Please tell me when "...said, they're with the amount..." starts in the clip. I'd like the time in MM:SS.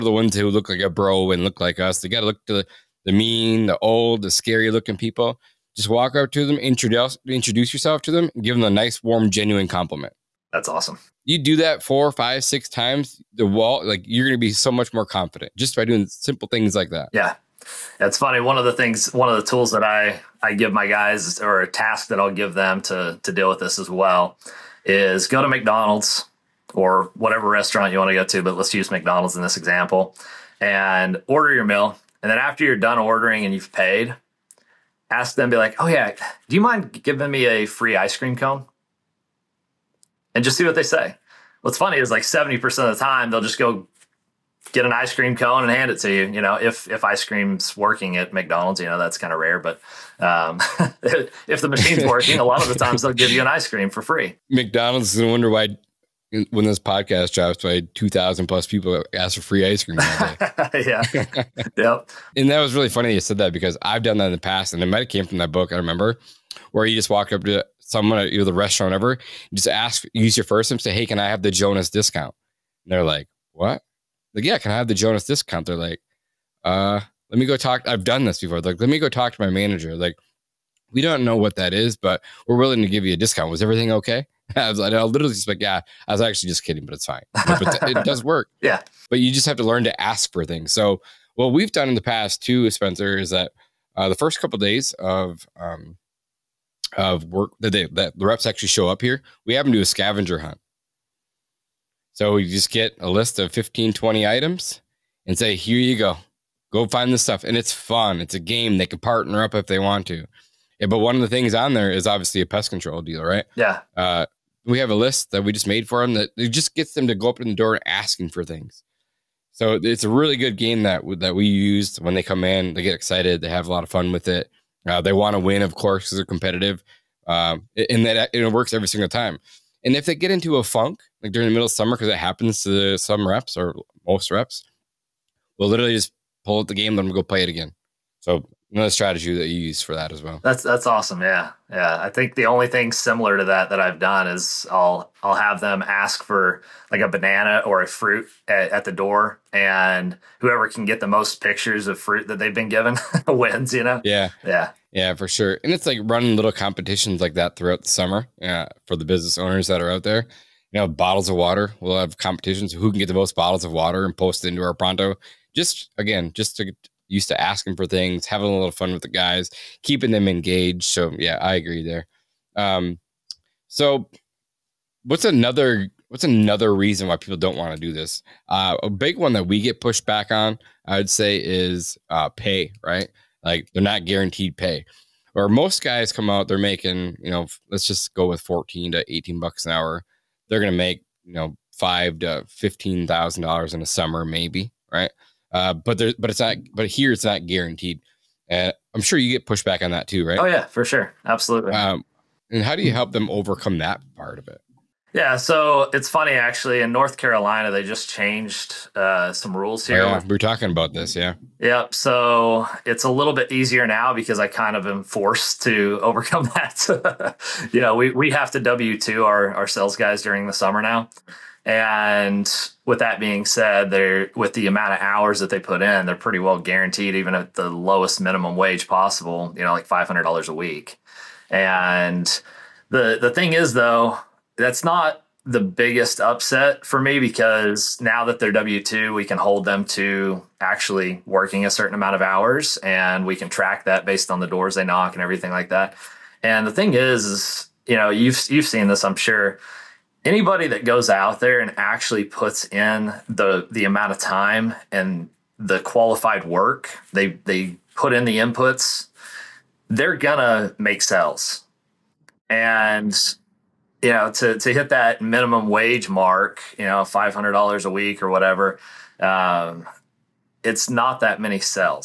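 03:43.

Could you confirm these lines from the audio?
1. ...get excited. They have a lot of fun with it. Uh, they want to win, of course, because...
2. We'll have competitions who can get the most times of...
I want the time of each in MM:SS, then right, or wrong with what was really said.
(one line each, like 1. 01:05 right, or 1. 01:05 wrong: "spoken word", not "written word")
1. 02:02 right
2. 02:41 wrong: "bottles", not "times".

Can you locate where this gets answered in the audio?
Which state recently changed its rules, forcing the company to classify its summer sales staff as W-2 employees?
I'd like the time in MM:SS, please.
03:26.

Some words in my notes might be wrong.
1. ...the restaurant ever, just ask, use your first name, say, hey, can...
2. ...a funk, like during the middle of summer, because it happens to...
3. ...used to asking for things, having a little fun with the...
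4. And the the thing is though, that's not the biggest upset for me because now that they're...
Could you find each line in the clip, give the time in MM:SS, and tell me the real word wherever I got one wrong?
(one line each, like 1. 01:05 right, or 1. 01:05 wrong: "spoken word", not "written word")
1. 01:08 right
2. 02:10 right
3. 02:47 right
4. 03:51 right.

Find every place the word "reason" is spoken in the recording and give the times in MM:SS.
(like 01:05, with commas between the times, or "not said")
02:56.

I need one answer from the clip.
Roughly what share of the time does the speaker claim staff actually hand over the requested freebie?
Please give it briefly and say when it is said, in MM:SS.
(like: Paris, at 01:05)
70%, at 00:42.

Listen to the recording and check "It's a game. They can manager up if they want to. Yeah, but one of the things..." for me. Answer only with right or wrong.
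wrong.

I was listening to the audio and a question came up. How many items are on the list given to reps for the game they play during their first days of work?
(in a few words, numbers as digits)
15, 20.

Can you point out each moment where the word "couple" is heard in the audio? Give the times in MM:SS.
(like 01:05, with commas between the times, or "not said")
01:34.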